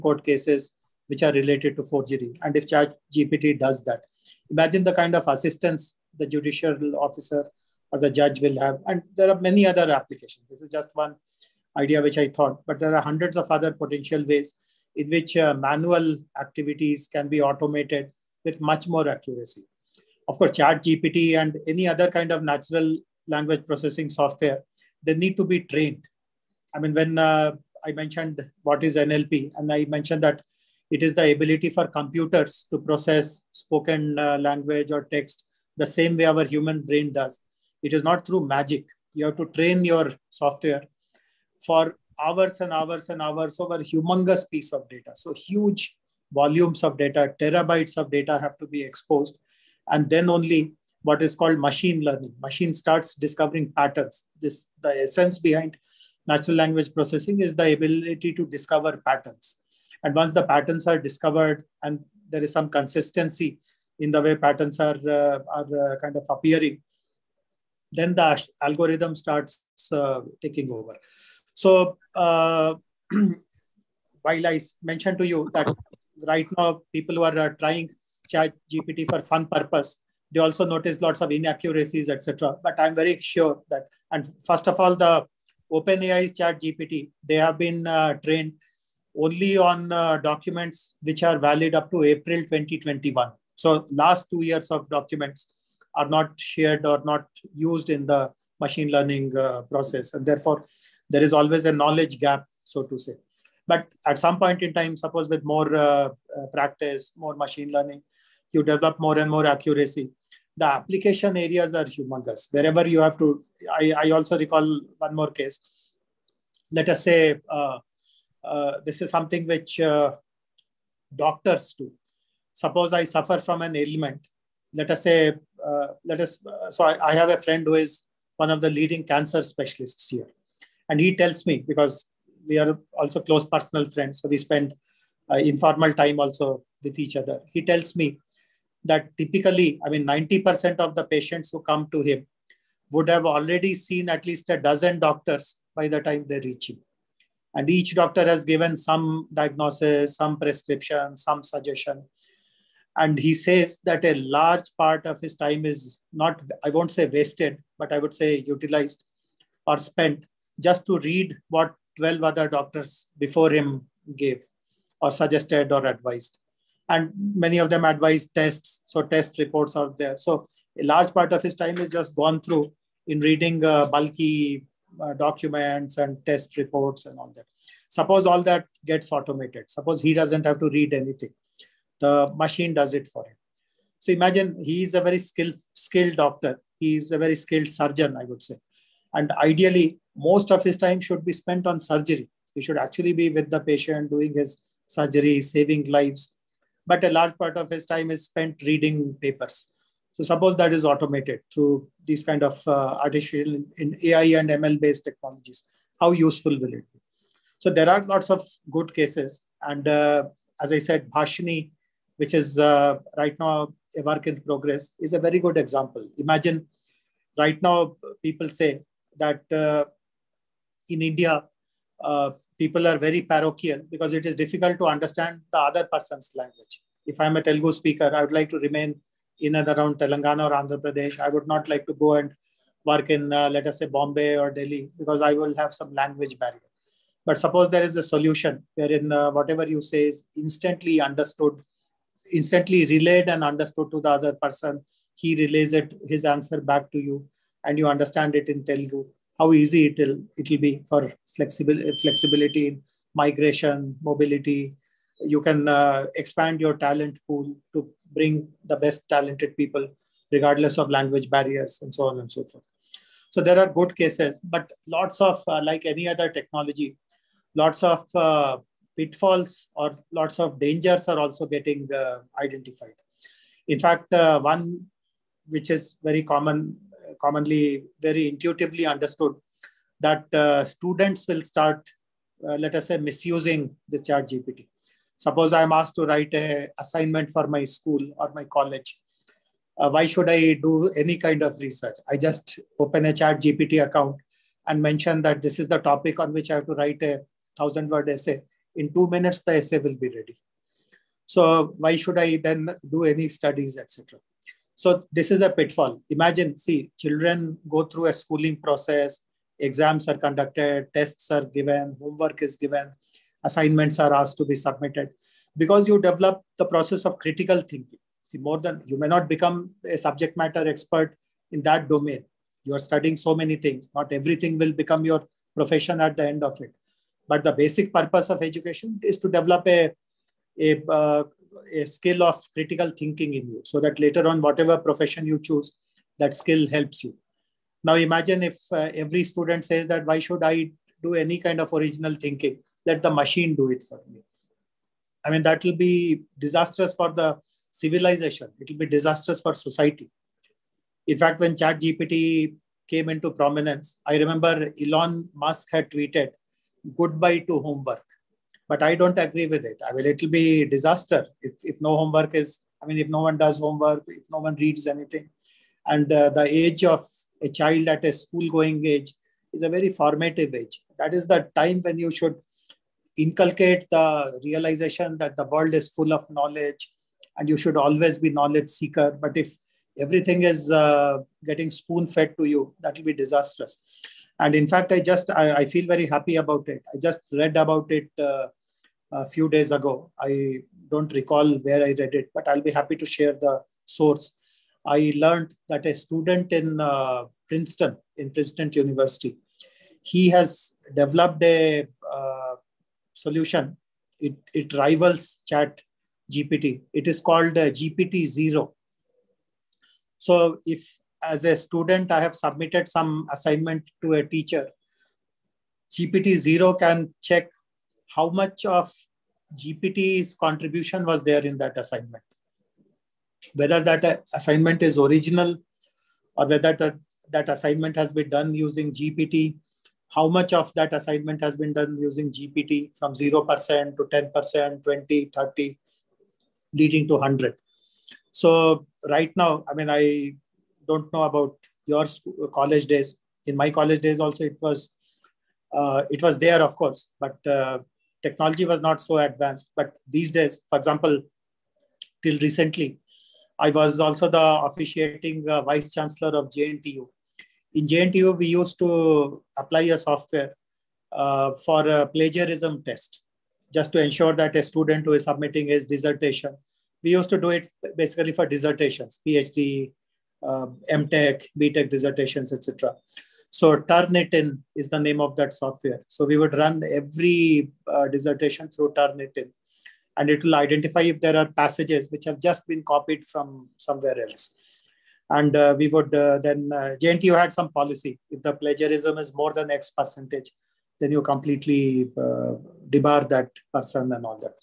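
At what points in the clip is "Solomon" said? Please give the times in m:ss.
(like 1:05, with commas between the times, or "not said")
not said.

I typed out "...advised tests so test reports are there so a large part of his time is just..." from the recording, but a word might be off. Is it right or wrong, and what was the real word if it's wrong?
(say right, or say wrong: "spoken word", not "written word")
right.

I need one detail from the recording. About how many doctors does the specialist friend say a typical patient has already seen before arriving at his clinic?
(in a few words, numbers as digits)
a dozen.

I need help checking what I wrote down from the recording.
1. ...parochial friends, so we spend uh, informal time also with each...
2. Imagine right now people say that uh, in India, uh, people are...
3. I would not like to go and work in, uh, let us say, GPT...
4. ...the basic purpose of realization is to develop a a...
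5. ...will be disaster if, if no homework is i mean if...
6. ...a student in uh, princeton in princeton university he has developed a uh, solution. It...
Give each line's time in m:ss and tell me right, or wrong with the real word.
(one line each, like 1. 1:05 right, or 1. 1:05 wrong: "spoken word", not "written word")
1. 2:13 wrong: "personal", not "parochial"
2. 3:36 right
3. 3:51 wrong: "Bombay", not "GPT"
4. 5:27 wrong: "education", not "realization"
5. 6:00 right
6. 6:35 right.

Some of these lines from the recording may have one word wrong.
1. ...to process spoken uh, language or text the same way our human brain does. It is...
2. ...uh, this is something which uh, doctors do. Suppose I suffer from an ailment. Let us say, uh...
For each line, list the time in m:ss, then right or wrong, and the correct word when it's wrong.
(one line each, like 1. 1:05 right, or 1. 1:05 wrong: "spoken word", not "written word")
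1. 0:32 right
2. 1:58 right.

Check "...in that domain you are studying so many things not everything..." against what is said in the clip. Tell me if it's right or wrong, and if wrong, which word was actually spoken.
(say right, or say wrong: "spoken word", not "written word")
right.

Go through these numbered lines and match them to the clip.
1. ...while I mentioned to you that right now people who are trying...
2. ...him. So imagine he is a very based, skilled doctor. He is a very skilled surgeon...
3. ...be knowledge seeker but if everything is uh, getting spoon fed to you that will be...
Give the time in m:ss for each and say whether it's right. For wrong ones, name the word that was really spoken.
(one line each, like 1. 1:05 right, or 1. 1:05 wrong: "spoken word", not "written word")
1. 1:13 right
2. 3:03 wrong: "skilled", not "based"
3. 6:18 right.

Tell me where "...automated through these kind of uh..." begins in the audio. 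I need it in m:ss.
3:20.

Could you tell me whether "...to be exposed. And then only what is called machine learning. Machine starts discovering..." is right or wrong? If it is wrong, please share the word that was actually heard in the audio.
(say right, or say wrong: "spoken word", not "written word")
right.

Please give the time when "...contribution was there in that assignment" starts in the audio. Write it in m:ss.
7:00.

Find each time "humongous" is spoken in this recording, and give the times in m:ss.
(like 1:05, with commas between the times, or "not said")
0:43, 1:51.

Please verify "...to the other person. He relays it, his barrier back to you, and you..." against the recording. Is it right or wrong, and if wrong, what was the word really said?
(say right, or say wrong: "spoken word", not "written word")
wrong: "answer", not "barrier".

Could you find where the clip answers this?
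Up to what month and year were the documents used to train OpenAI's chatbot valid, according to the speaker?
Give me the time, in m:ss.
1:32.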